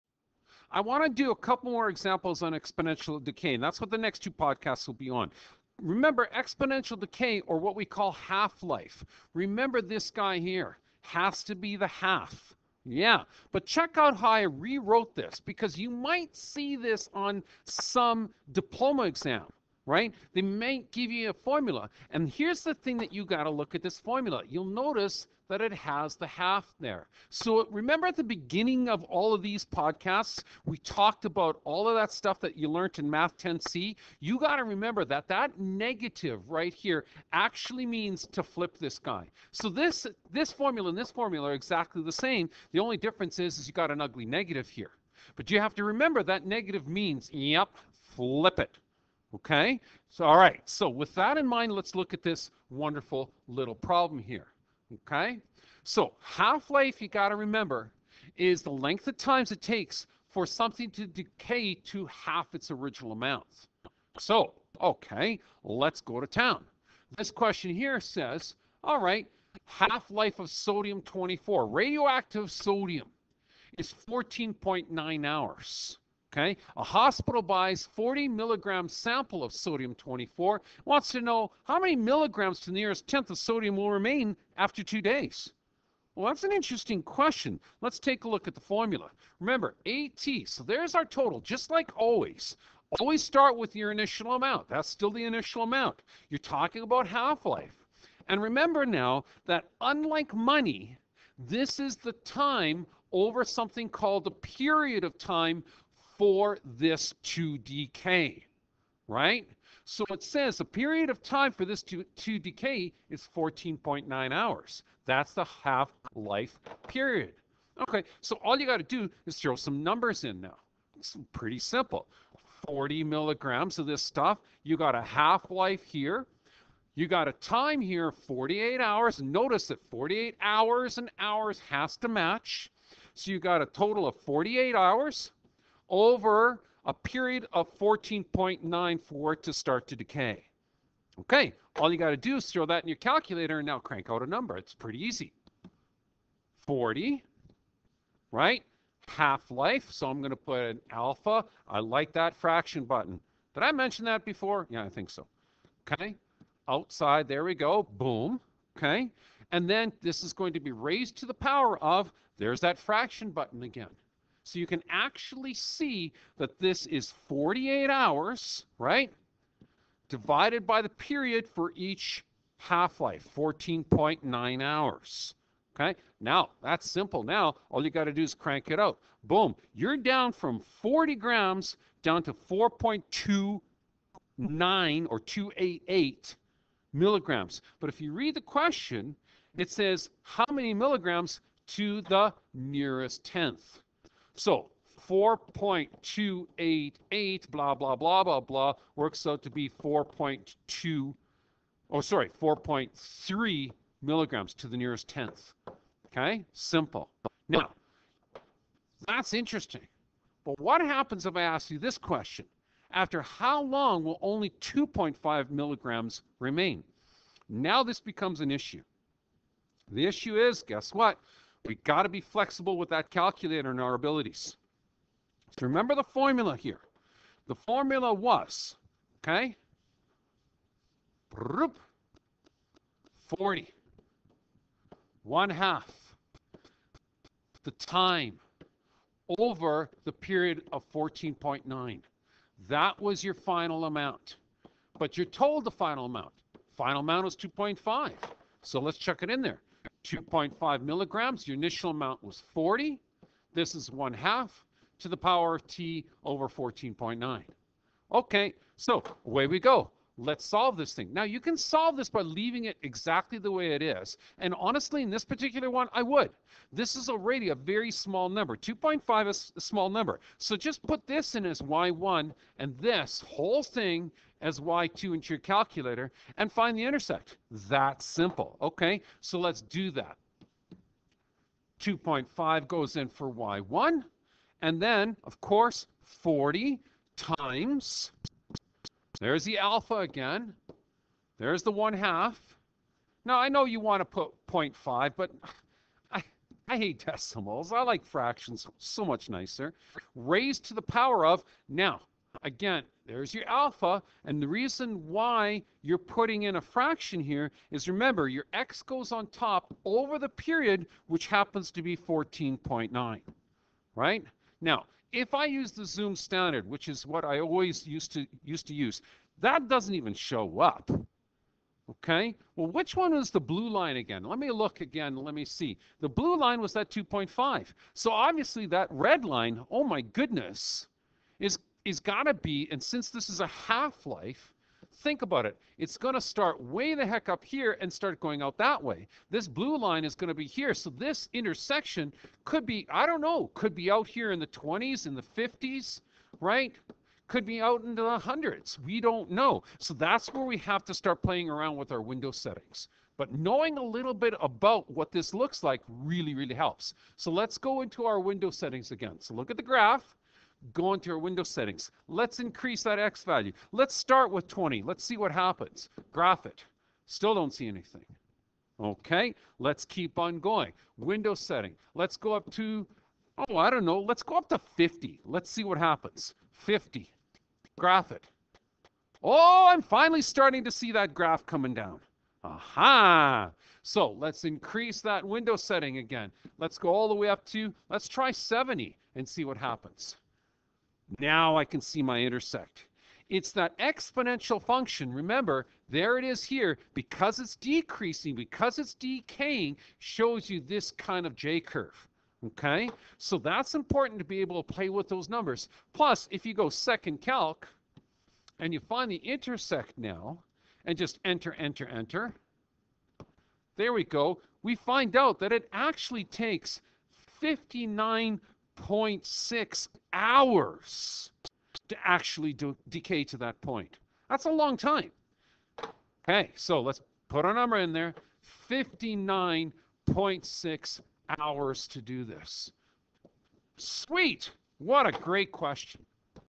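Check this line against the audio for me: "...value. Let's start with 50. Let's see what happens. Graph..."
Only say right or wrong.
wrong.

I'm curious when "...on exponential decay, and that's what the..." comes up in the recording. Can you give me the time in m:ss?
0:02.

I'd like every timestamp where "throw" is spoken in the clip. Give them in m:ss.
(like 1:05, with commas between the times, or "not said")
1:59, 2:22.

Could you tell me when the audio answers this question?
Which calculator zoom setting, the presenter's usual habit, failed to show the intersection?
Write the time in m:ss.
5:15.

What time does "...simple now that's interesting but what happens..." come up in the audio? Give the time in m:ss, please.
3:26.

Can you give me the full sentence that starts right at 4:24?
And honestly, in this particular one, I would.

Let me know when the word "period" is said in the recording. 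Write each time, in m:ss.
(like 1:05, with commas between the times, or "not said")
1:44, 1:50, 1:56, 2:16, 2:50, 4:00, 5:10.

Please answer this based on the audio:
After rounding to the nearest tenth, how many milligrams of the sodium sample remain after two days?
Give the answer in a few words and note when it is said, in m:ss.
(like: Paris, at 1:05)
4.3 milligrams, at 3:22.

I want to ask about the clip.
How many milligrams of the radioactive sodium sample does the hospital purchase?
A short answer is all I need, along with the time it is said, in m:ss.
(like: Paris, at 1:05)
40 milligrams, at 1:17.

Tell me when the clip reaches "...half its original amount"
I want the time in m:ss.
1:02.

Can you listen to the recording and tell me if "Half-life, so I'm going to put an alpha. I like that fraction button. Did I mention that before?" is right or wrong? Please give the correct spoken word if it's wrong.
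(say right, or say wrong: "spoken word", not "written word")
right.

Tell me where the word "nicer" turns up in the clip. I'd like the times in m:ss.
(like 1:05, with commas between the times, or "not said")
4:59.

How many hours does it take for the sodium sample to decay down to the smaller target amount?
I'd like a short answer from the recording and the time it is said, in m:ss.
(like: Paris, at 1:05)
59.6 hours, at 7:08.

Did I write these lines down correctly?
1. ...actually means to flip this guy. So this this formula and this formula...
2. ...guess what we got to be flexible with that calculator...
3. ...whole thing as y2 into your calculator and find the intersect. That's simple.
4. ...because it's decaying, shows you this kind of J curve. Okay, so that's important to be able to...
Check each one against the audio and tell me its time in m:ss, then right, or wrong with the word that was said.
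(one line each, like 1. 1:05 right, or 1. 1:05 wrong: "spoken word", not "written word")
1. 0:37 right
2. 3:40 right
3. 4:33 right
4. 6:38 right.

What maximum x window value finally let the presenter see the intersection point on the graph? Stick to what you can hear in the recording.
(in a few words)
70.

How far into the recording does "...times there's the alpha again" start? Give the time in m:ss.
4:47.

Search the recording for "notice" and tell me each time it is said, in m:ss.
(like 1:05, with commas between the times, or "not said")
0:24, 2:09.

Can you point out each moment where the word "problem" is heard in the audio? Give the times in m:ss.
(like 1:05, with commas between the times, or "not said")
0:53.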